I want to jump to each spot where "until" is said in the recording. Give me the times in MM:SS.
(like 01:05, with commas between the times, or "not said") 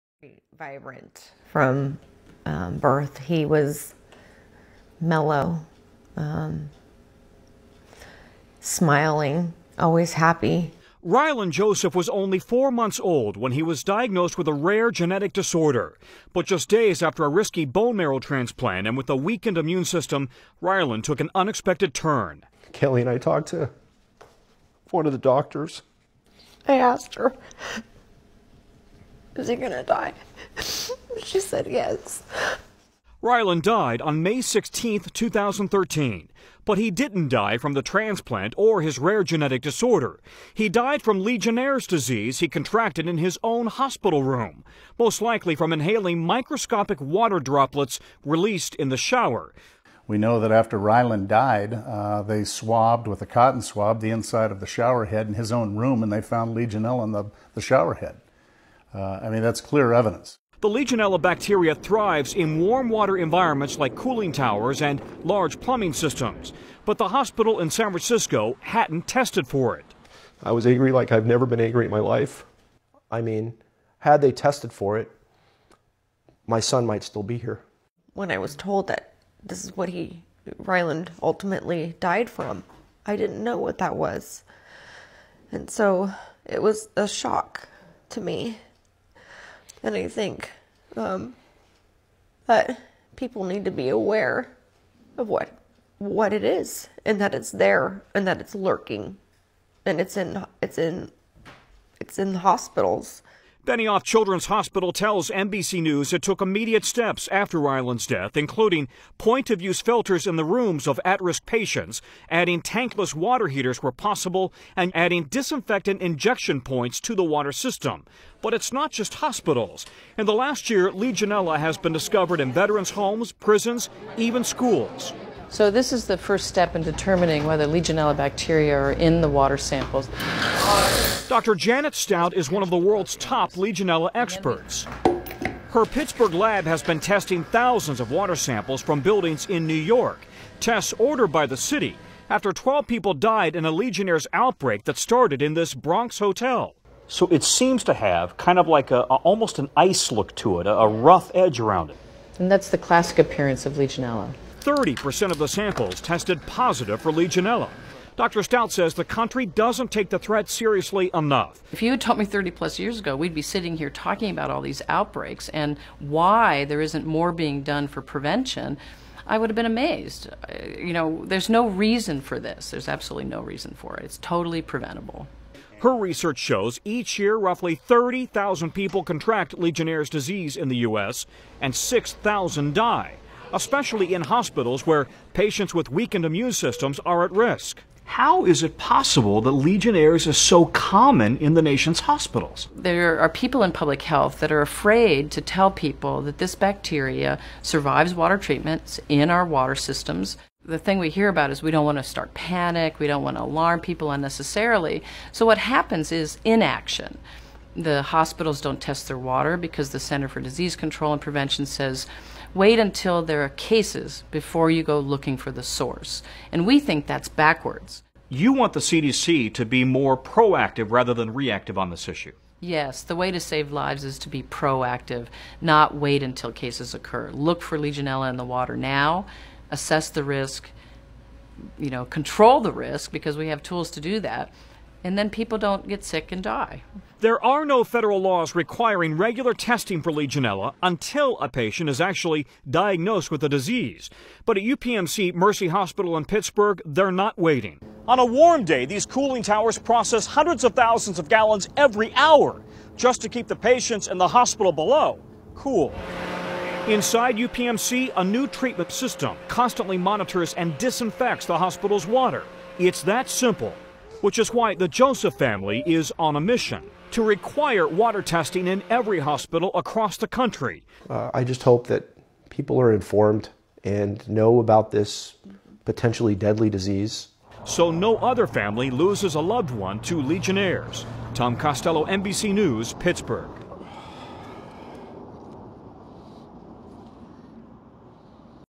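03:32, 03:46, 04:00.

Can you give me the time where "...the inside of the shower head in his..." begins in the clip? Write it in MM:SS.
00:54.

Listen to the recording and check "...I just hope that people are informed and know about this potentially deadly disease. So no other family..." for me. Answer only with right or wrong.
right.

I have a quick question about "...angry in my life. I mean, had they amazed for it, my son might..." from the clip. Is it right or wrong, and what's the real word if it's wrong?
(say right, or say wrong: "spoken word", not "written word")
wrong: "tested", not "amazed".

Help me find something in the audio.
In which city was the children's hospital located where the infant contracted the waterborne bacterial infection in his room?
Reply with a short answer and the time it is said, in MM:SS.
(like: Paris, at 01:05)
San Francisco, at 01:07.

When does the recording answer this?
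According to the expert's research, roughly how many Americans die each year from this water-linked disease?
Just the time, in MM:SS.
03:01.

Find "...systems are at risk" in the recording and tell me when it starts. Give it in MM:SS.
03:06.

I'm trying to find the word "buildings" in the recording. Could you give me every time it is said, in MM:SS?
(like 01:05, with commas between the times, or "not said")
02:18.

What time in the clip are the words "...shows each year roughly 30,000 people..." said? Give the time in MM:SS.
02:56.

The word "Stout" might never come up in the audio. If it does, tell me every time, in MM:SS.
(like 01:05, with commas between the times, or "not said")
02:11, 02:38.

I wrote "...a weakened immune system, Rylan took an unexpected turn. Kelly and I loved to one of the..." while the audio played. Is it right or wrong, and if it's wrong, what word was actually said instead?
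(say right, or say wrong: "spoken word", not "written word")
wrong: "talked", not "loved".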